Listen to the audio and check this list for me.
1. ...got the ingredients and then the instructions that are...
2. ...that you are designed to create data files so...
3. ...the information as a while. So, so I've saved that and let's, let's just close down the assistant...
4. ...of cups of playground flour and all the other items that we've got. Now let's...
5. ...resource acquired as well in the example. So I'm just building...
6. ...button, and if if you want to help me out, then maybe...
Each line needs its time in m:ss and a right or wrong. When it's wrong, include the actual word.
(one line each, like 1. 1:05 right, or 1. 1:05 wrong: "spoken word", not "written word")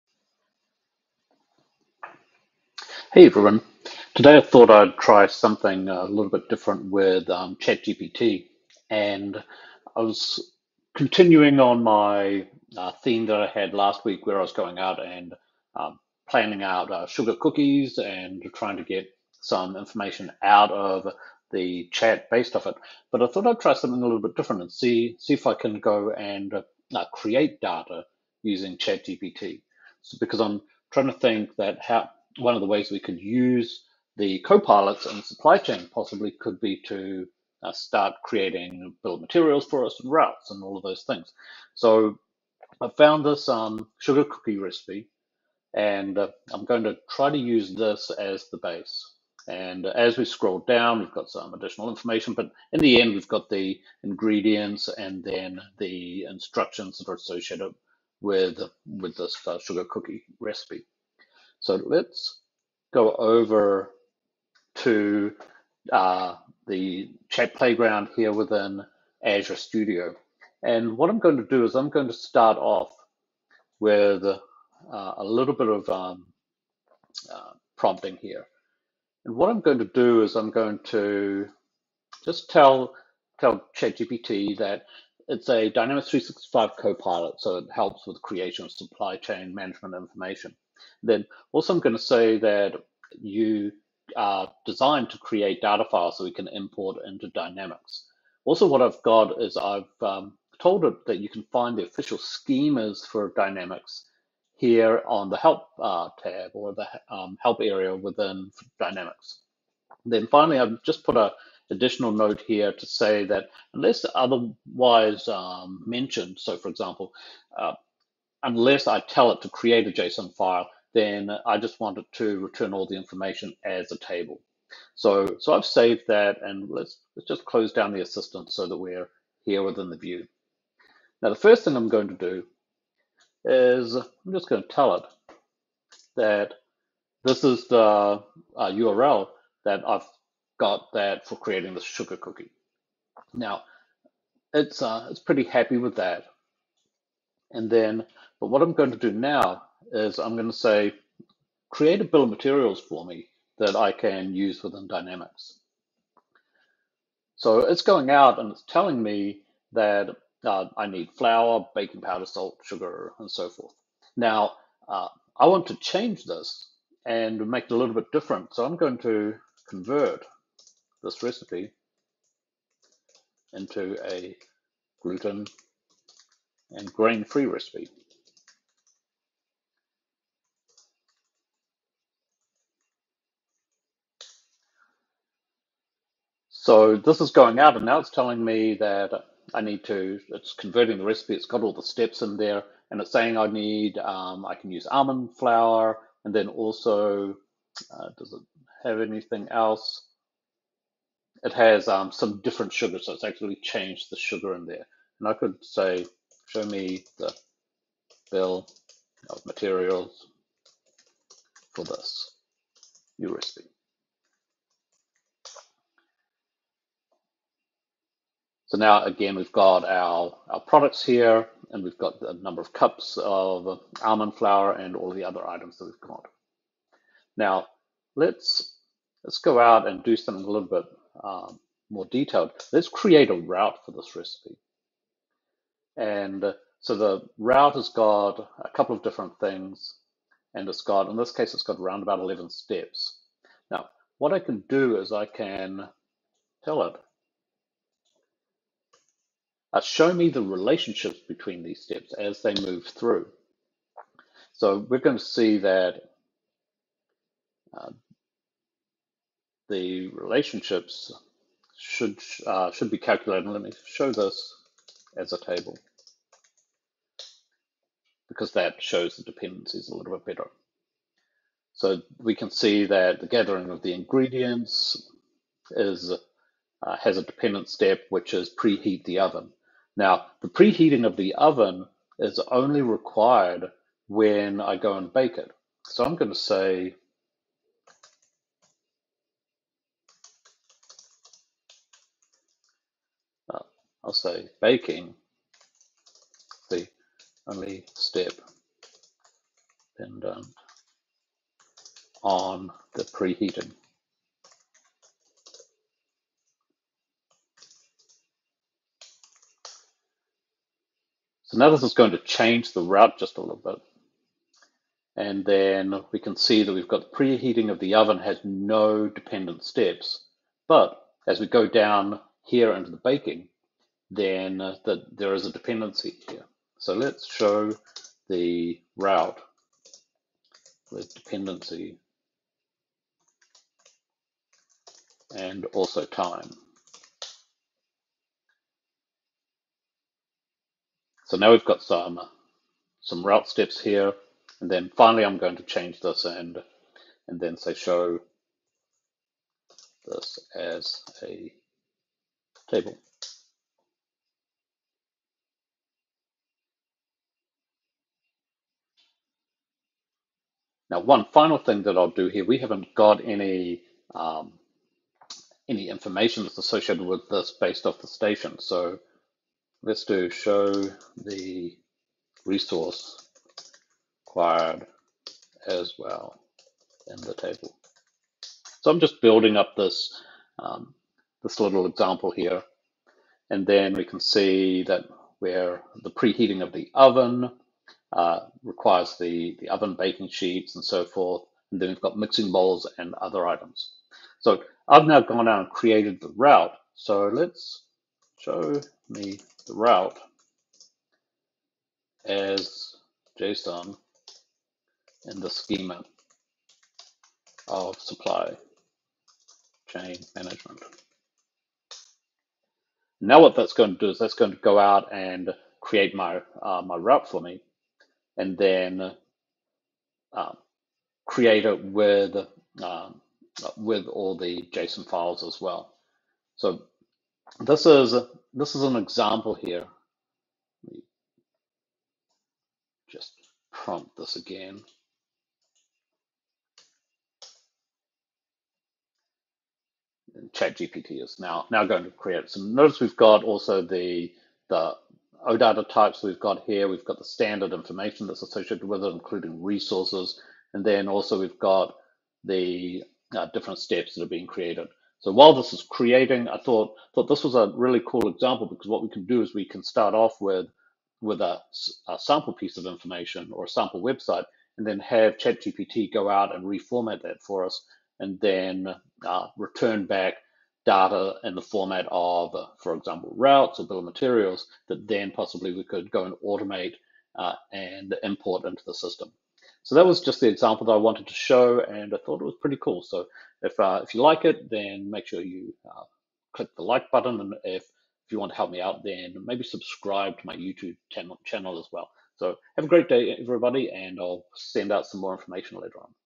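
1. 0:53 right
2. 1:32 right
3. 2:02 wrong: "table", not "while"
4. 3:42 wrong: "almond", not "playground"
5. 6:12 wrong: "table", not "example"
6. 8:07 right.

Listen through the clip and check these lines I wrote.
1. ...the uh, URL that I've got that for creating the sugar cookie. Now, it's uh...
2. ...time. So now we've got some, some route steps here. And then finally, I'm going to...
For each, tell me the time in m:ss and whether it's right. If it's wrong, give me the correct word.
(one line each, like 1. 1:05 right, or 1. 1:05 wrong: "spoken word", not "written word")
1. 2:17 right
2. 5:36 right.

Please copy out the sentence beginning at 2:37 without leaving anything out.
So it's going out and it's telling me that uh, I need flour, baking powder, salt, sugar, and so forth.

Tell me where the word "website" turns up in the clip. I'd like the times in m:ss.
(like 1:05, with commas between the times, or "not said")
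7:44.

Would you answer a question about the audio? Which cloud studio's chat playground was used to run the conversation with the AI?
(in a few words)
Azure Studio.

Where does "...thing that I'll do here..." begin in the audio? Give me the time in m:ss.
6:01.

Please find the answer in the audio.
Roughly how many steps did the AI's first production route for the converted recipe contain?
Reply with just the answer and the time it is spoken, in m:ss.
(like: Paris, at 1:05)
11, at 4:02.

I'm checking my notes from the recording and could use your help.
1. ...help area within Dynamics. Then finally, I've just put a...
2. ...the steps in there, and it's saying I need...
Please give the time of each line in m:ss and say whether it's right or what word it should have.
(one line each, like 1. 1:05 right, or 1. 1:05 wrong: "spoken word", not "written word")
1. 1:47 right
2. 3:11 right.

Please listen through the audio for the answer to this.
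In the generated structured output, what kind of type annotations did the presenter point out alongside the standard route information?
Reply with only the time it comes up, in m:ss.
7:25.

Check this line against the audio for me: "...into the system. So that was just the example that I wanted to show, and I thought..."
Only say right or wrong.
right.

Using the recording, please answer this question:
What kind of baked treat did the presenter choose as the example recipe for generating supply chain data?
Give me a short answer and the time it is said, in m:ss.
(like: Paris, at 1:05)
Sugar cookies, at 0:17.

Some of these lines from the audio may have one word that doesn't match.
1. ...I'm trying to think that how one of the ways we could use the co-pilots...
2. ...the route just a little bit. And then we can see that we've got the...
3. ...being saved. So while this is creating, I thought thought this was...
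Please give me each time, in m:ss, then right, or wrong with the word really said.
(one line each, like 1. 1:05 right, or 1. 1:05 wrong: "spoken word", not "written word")
1. 0:30 right
2. 5:12 right
3. 7:34 wrong: "created", not "saved".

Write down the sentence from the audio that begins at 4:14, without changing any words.
So we're going to see that uh, the relationships should uh, should be calculated.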